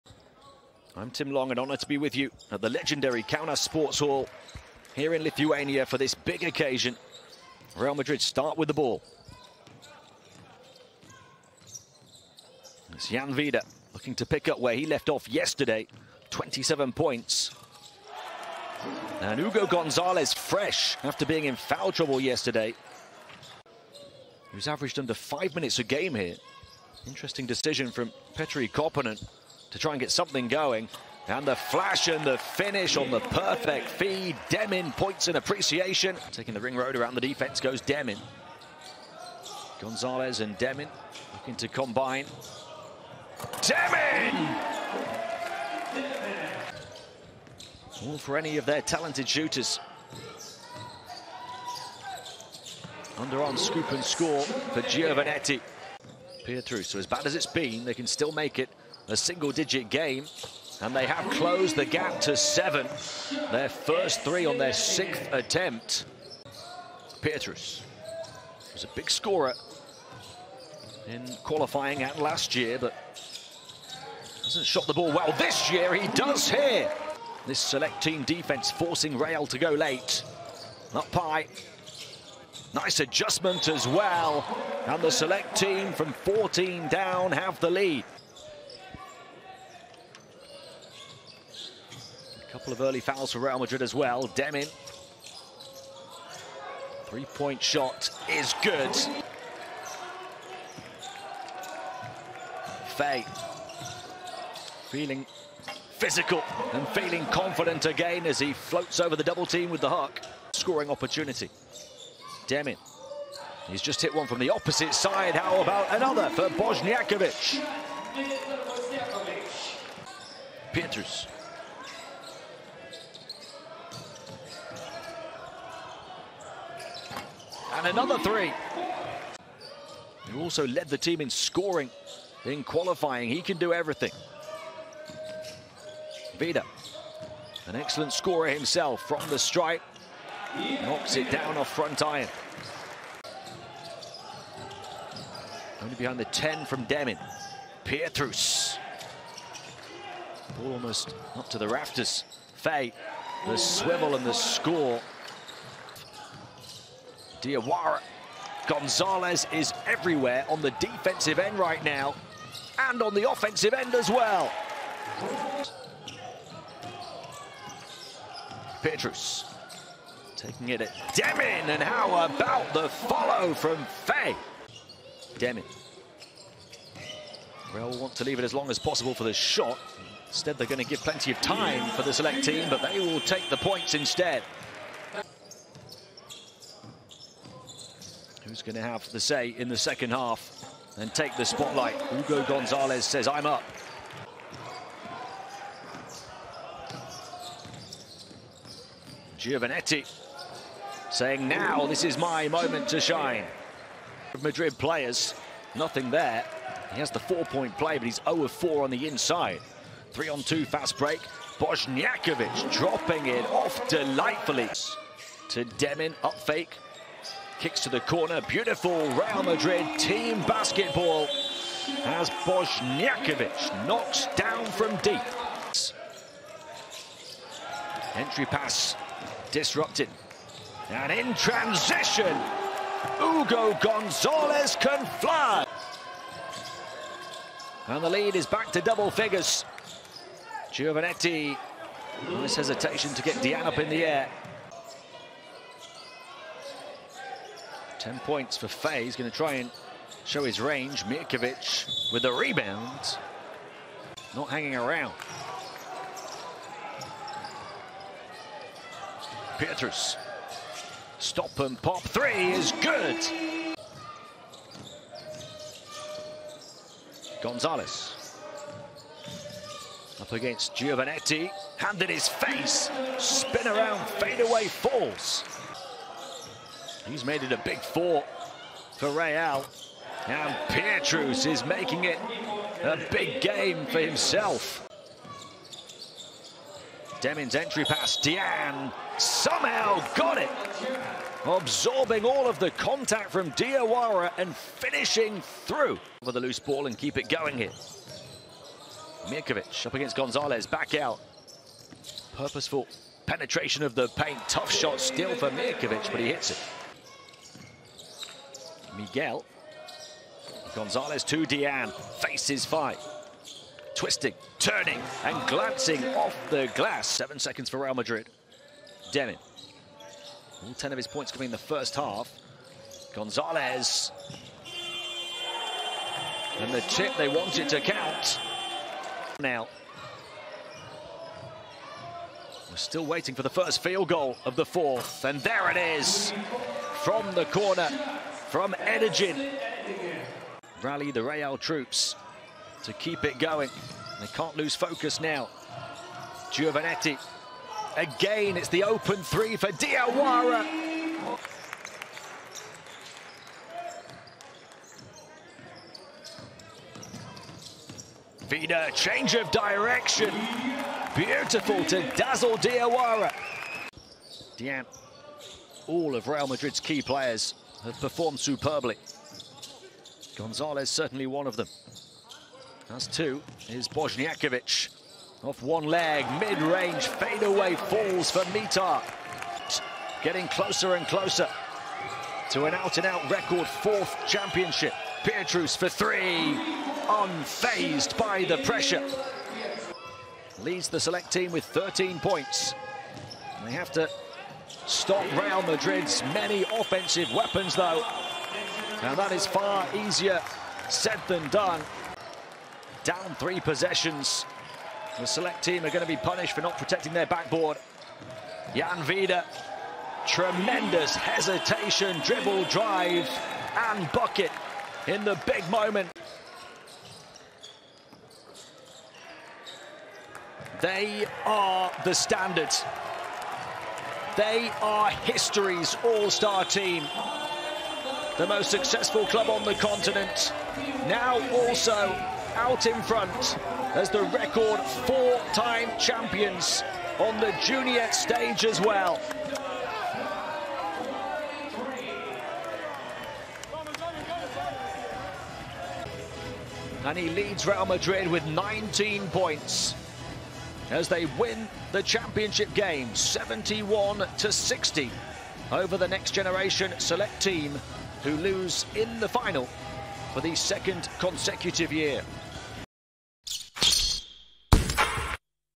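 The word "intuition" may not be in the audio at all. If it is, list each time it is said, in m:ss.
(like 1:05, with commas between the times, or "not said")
not said.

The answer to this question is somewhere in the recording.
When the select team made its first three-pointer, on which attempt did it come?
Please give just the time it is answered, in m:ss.
1:04.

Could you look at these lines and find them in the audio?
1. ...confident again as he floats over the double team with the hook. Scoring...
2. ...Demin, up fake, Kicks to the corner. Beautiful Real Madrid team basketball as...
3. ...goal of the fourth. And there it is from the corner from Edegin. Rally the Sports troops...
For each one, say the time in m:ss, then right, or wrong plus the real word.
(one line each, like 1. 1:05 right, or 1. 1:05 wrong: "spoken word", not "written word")
1. 1:47 right
2. 3:35 right
3. 5:34 wrong: "Real", not "Sports".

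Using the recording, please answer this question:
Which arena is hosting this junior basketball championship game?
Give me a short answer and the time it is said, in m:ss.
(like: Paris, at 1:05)
Kaunas Sports Hall, at 0:03.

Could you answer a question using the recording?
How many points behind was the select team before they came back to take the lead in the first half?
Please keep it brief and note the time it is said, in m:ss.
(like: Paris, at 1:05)
14, at 1:26.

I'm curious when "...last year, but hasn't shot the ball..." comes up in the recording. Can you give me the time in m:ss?
1:12.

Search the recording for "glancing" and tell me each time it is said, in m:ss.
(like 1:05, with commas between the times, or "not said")
5:15.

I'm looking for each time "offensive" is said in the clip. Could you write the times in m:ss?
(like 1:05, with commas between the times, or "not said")
2:43, 6:36.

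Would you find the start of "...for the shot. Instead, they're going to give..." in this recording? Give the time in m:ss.
2:59.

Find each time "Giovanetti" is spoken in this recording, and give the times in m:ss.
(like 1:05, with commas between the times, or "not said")
0:54, 3:19, 4:00, 4:30, 5:46.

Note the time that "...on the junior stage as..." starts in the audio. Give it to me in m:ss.
7:17.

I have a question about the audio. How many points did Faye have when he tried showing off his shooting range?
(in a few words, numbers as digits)
10.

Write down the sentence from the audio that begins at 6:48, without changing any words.
Jan Vide, tremendous hesitation, dribble, drive, and bucket in the big moment.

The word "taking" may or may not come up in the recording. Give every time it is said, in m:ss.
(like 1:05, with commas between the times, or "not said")
0:36, 2:50.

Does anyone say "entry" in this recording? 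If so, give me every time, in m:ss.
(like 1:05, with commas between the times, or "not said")
3:48, 4:47.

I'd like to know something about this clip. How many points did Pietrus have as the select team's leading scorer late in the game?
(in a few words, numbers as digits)
13.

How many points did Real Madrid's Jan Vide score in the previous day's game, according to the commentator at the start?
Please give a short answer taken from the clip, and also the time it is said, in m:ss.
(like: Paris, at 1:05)
27, at 0:16.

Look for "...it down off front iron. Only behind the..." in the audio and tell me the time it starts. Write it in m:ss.
2:21.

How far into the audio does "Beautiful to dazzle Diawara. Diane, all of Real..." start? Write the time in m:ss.
6:01.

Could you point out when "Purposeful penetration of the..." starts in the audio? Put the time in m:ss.
5:02.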